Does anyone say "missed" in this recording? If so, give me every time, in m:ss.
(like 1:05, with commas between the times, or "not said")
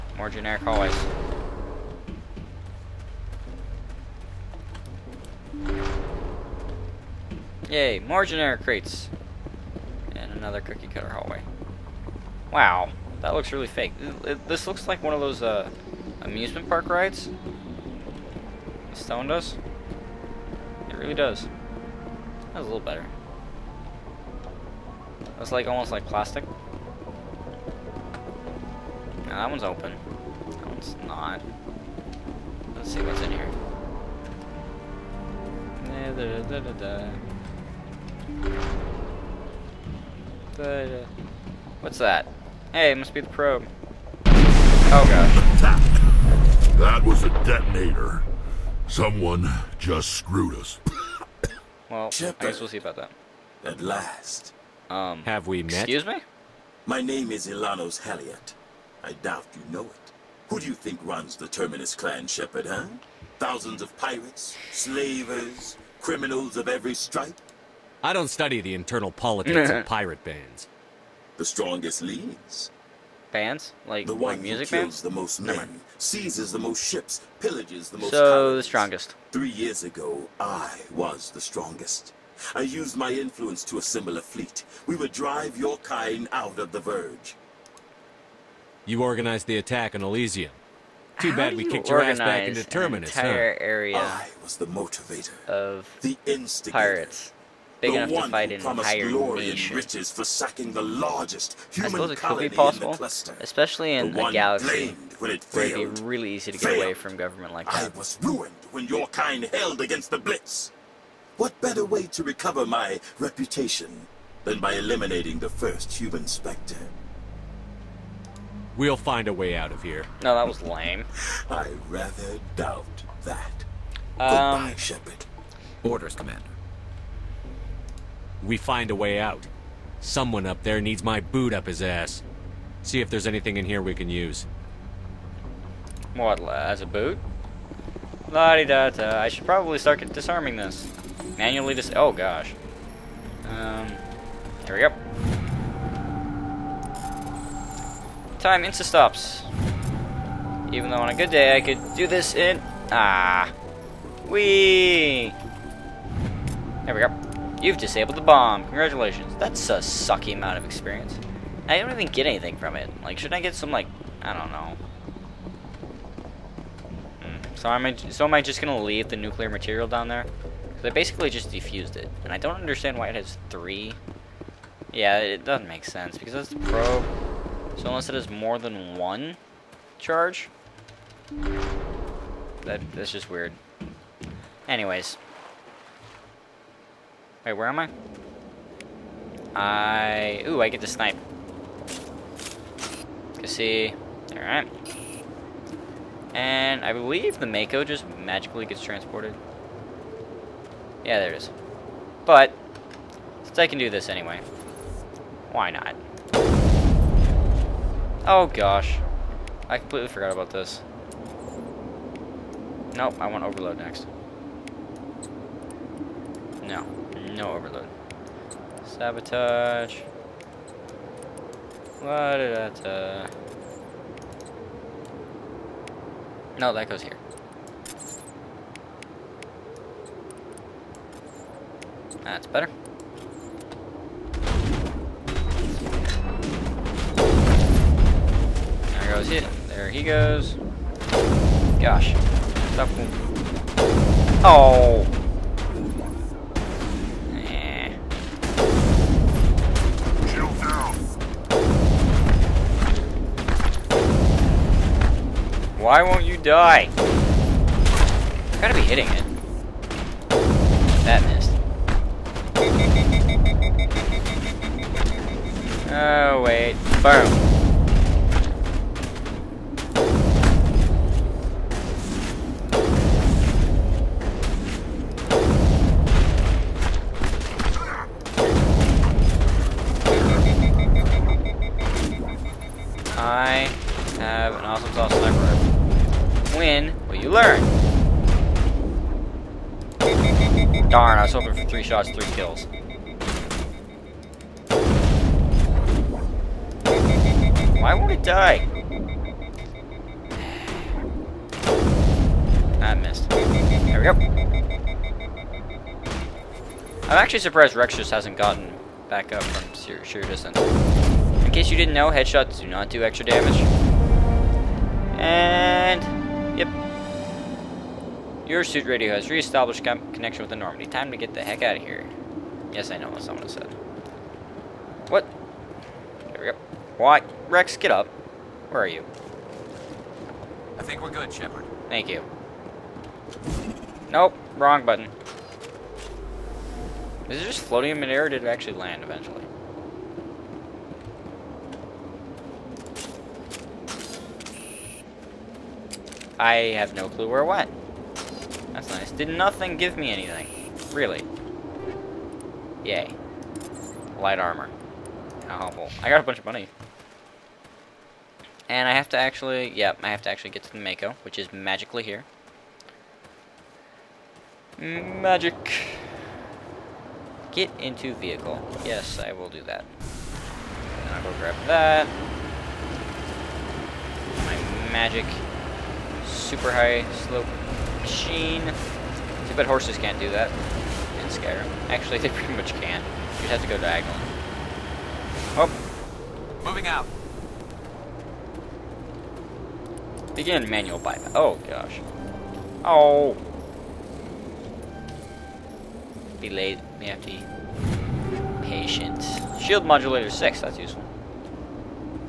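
4:21, 5:02.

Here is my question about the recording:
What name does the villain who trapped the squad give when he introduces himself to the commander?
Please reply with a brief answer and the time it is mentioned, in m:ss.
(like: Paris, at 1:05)
Elanos Haliat, at 0:57.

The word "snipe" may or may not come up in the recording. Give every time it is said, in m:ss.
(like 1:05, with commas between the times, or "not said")
3:10.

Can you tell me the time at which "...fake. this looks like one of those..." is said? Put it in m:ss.
0:13.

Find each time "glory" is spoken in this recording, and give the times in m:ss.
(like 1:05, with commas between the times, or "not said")
1:39.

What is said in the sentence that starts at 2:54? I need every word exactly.
Yeah, it doesn't make sense, because that's the probe...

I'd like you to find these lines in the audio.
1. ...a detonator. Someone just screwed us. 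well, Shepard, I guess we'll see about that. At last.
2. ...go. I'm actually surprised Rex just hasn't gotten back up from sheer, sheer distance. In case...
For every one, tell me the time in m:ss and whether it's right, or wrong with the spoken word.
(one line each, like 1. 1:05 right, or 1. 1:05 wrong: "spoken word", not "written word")
1. 0:47 right
2. 5:04 right.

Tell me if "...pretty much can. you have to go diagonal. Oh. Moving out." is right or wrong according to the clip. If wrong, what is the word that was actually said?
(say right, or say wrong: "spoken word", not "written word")
right.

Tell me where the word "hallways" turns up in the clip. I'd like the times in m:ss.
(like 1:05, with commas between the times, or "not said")
0:00, 0:11.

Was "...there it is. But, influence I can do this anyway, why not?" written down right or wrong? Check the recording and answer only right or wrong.
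wrong.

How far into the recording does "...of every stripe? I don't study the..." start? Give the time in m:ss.
1:06.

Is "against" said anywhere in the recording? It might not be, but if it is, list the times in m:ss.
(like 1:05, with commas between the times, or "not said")
1:49.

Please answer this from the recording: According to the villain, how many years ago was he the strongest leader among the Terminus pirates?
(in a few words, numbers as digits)
3.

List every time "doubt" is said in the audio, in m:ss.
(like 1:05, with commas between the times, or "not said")
0:59, 2:02.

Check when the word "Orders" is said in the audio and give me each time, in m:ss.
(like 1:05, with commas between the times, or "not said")
2:05.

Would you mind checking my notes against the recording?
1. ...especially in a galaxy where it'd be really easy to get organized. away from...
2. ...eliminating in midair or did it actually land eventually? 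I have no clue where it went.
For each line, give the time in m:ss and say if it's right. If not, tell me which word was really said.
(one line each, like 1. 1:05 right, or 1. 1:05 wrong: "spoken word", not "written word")
1. 1:43 wrong: "failed", not "organized"
2. 5:37 wrong: "floating", not "eliminating".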